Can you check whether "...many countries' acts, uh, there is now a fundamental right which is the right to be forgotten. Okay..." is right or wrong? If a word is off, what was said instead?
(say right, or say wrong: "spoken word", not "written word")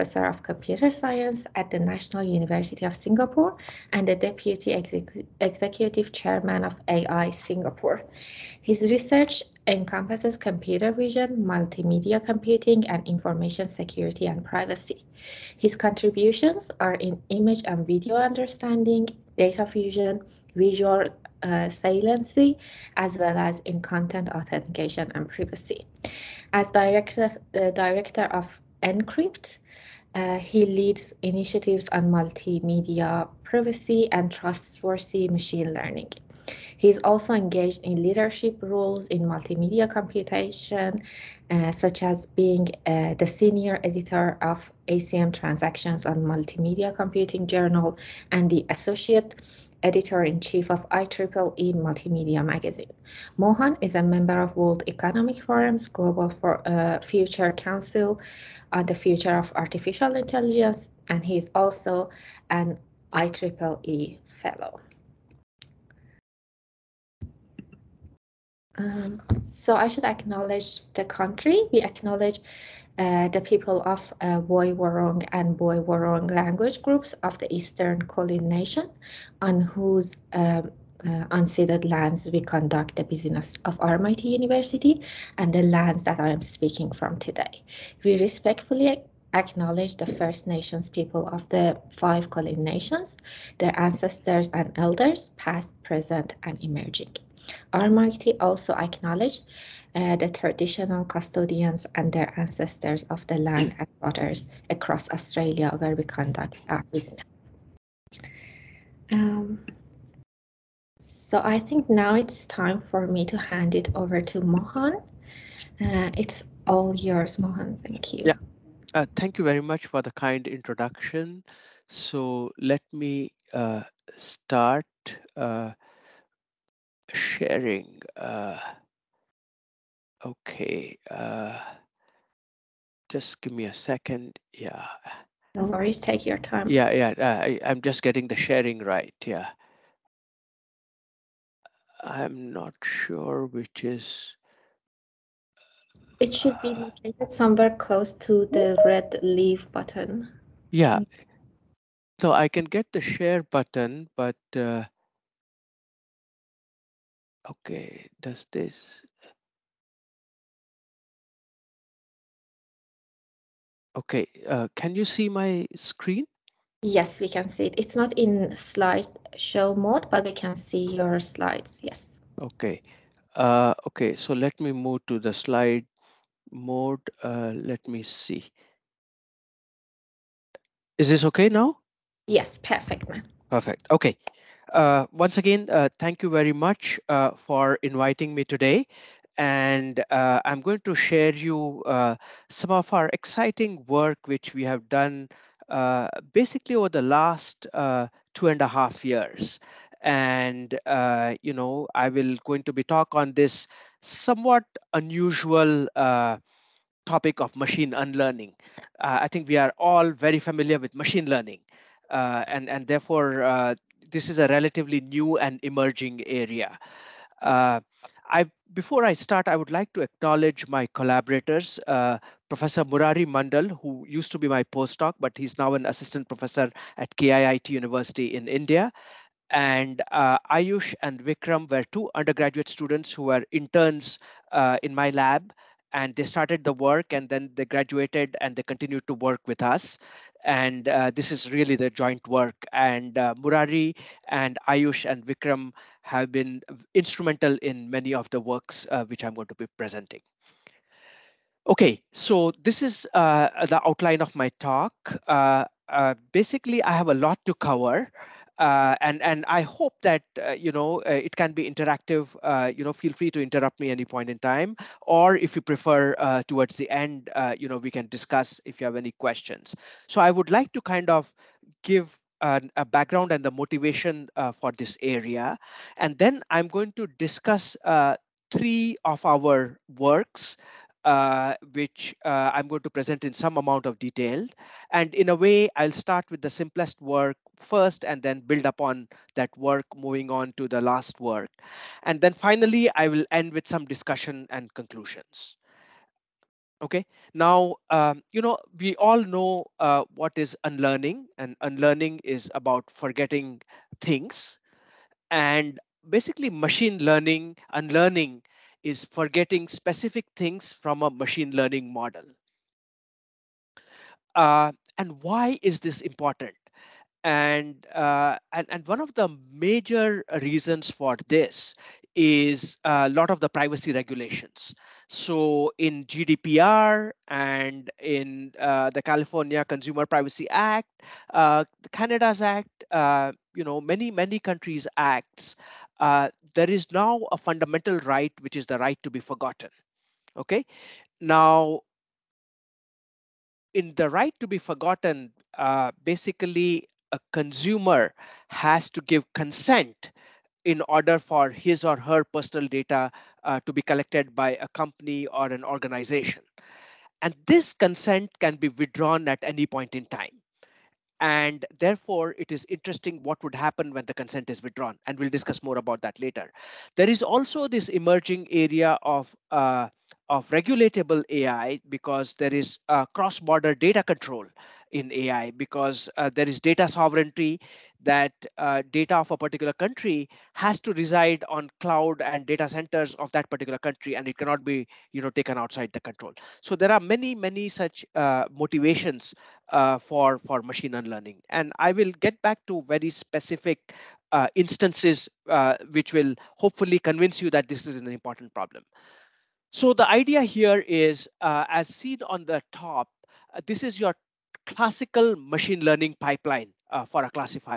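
right.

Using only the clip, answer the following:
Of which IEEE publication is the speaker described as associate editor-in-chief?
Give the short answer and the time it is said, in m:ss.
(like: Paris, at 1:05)
IEEE Multimedia Magazine, at 0:50.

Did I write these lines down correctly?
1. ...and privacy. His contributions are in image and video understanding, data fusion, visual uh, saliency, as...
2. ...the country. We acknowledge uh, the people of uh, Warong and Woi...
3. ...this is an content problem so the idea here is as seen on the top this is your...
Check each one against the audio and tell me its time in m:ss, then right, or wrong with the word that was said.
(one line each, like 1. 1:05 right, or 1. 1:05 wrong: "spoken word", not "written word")
1. 0:14 right
2. 1:10 right
3. 6:37 wrong: "important", not "content".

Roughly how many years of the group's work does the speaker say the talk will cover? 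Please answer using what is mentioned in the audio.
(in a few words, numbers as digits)
2.5 years.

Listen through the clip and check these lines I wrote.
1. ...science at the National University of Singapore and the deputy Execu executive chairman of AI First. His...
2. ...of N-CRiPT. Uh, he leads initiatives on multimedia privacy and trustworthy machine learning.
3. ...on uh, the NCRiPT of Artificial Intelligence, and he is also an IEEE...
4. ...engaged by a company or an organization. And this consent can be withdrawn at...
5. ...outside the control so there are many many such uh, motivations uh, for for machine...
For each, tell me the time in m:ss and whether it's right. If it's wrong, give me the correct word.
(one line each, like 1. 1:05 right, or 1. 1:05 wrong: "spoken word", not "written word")
1. 0:00 wrong: "Singapore", not "First"
2. 0:28 right
3. 0:58 wrong: "Future", not "NCRiPT"
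4. 5:53 wrong: "collected", not "engaged"
5. 6:25 right.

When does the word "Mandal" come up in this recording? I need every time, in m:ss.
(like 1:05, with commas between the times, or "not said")
3:43.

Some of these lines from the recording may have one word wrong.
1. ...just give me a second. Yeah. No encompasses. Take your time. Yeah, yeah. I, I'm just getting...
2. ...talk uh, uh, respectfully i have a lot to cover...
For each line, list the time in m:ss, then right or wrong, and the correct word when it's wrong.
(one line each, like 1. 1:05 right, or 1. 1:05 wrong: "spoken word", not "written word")
1. 2:13 wrong: "worries", not "encompasses"
2. 4:14 wrong: "basically", not "respectfully".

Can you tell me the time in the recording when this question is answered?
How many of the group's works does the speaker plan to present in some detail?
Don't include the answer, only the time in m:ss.
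4:38.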